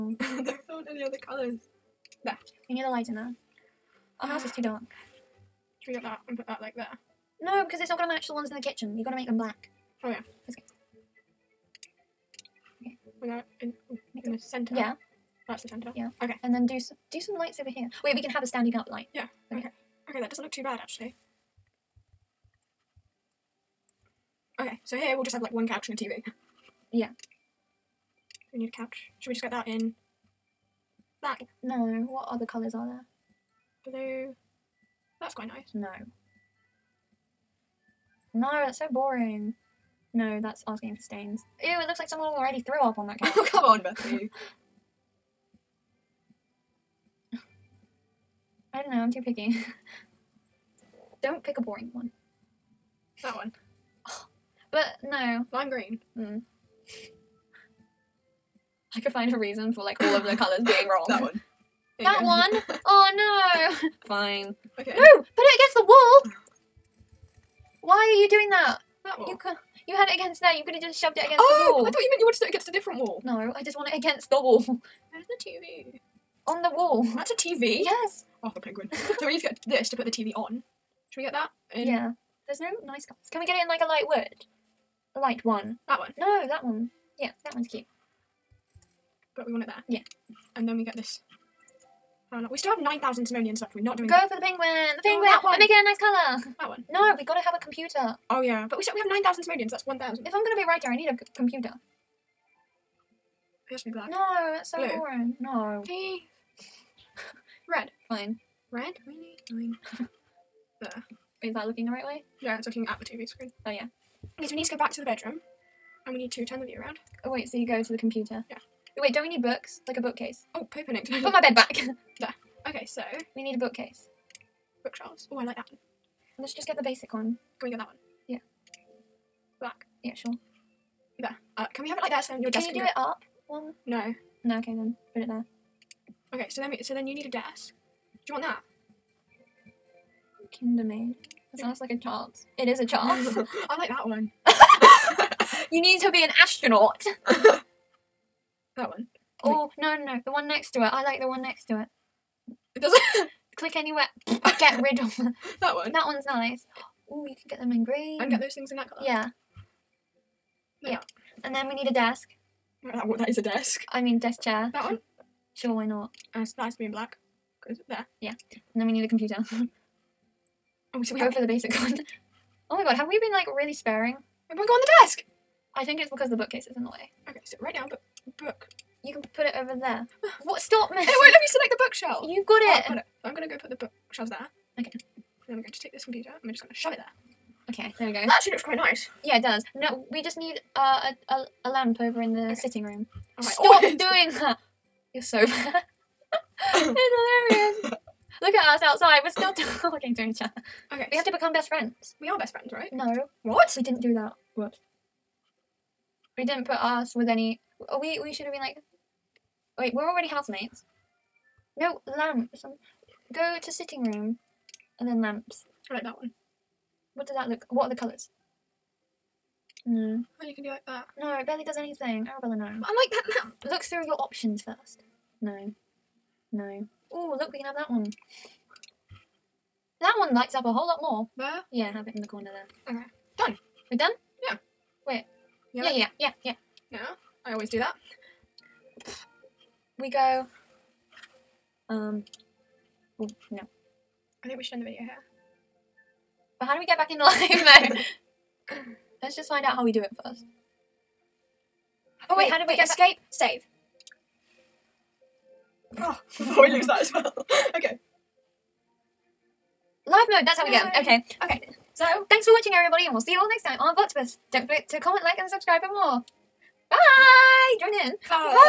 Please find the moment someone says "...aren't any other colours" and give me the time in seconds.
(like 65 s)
0 s.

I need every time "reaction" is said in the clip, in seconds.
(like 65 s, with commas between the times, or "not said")
not said.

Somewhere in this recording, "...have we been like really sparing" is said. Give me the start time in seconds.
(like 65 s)
172 s.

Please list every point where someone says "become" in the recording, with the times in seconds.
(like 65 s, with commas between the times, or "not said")
201 s.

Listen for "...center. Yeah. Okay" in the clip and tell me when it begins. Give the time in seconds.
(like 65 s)
15 s.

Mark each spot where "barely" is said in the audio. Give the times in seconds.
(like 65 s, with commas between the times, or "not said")
221 s.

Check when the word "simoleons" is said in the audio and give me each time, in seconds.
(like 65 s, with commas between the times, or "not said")
93 s, 99 s.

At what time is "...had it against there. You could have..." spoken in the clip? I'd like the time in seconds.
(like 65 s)
69 s.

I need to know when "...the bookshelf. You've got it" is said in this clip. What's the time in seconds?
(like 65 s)
181 s.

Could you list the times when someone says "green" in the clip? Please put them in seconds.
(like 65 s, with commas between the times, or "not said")
55 s, 157 s.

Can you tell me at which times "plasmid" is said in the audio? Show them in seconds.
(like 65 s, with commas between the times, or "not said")
not said.